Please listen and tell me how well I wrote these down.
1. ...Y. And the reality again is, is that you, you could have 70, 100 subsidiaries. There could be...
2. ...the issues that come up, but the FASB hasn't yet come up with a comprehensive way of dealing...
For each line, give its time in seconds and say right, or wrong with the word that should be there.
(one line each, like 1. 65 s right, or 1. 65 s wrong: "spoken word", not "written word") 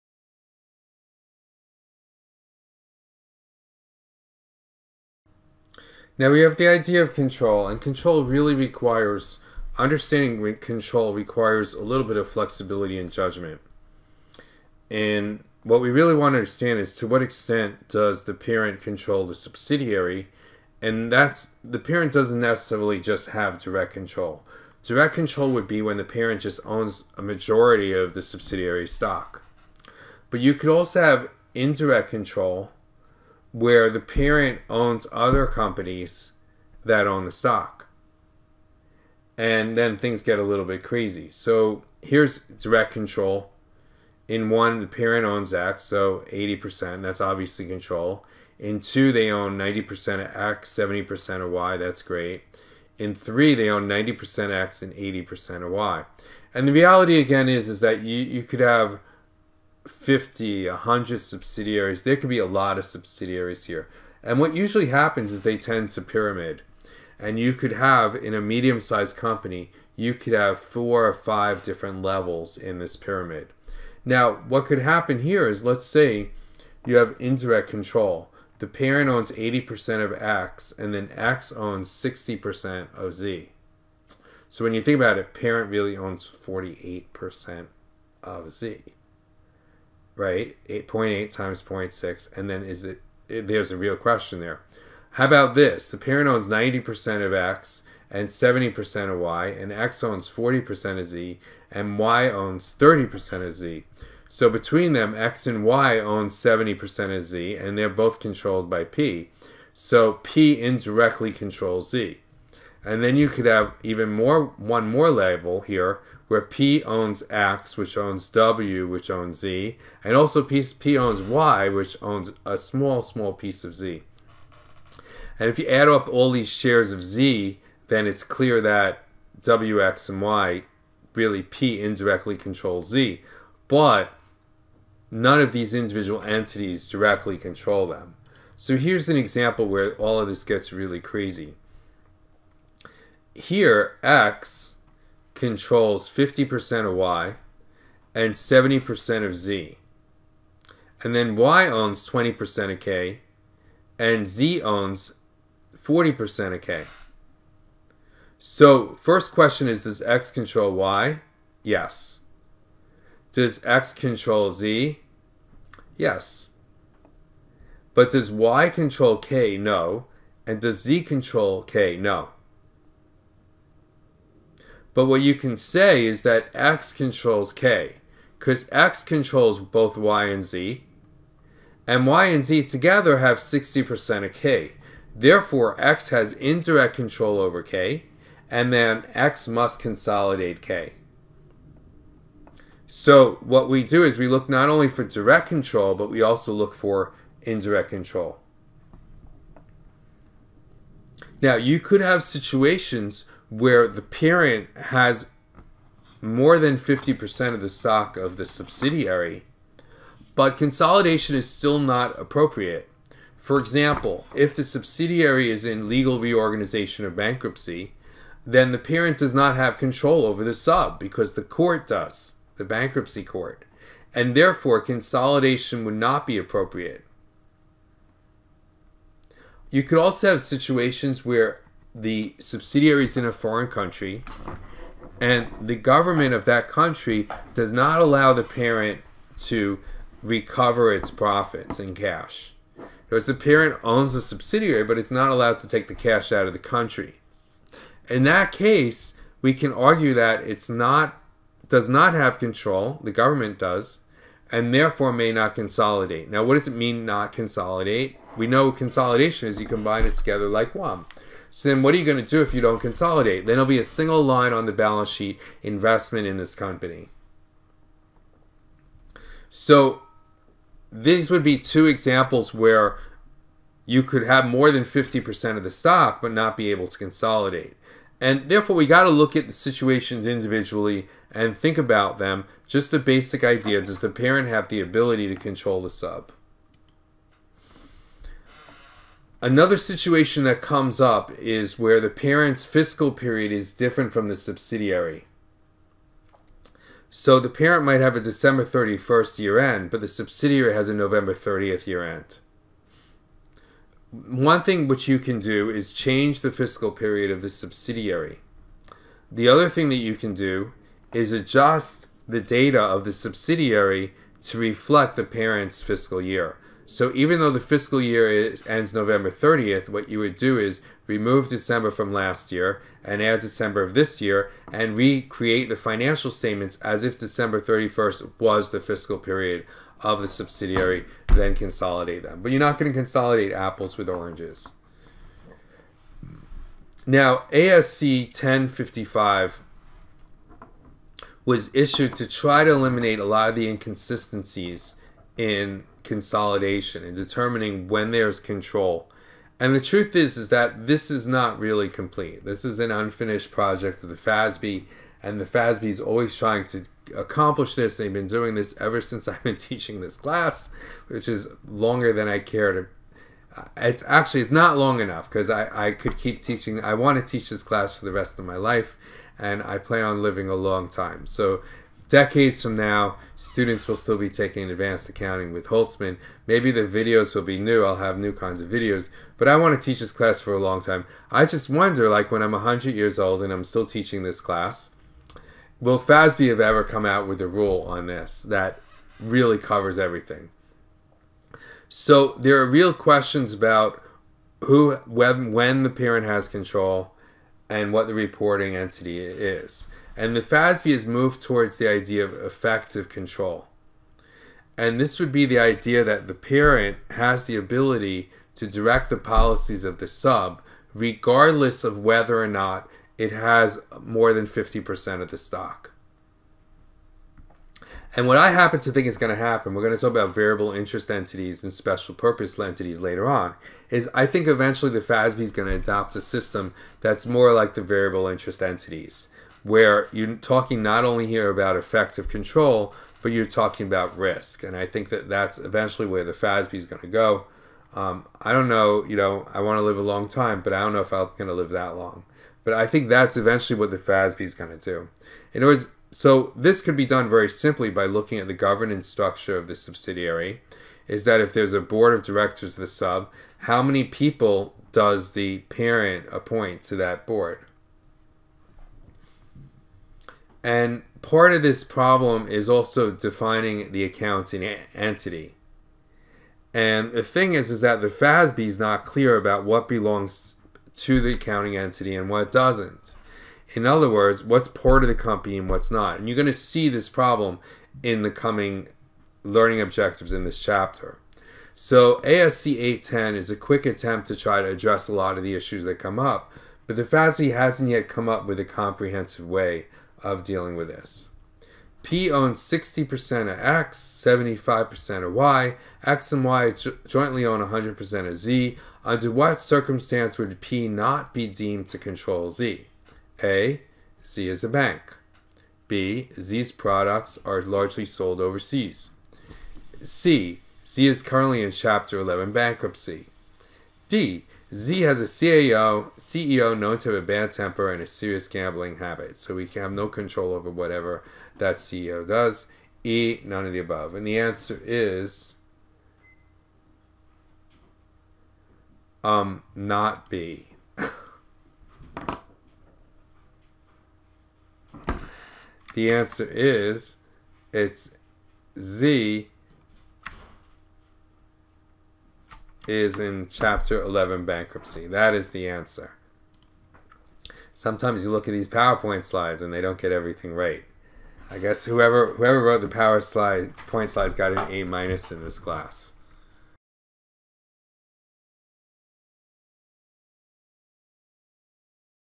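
1. 55 s wrong: "50", not "70"
2. 485 s right.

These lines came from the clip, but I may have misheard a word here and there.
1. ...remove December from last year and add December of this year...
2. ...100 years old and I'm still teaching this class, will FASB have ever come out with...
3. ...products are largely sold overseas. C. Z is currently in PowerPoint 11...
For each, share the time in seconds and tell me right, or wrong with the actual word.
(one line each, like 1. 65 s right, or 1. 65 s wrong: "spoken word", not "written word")
1. 321 s right
2. 382 s right
3. 506 s wrong: "Chapter", not "PowerPoint".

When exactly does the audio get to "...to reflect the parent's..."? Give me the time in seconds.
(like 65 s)
314 s.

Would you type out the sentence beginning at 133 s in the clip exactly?
But none of these individual entities directly control them.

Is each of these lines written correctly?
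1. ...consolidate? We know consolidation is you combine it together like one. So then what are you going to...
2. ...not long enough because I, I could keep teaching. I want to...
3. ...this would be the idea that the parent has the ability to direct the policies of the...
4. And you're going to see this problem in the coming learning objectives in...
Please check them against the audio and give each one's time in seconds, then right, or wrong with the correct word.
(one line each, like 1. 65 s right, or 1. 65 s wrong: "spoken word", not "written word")
1. 257 s right
2. 364 s right
3. 404 s right
4. 476 s right.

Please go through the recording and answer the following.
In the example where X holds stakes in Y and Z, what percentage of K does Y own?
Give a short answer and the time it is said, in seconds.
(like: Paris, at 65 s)
20%, at 152 s.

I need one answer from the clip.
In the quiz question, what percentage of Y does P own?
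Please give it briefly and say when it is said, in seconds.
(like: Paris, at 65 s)
75%, at 493 s.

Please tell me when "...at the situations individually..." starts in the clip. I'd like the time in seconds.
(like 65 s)
279 s.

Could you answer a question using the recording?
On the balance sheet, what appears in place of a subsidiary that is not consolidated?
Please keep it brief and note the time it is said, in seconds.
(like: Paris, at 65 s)
investment in this company, at 265 s.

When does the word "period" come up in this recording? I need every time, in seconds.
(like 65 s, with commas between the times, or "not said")
293 s, 306 s, 329 s.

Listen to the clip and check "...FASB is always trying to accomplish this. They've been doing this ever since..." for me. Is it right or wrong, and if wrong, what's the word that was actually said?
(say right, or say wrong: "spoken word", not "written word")
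right.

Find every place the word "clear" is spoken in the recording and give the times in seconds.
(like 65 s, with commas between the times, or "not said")
128 s, 469 s.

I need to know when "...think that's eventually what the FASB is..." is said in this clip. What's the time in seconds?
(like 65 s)
442 s.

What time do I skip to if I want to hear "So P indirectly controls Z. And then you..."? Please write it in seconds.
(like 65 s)
109 s.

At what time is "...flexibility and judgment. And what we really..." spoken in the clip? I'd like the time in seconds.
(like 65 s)
12 s.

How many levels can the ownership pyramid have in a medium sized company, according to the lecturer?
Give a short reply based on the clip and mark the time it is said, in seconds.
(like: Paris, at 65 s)
4 or 5, at 70 s.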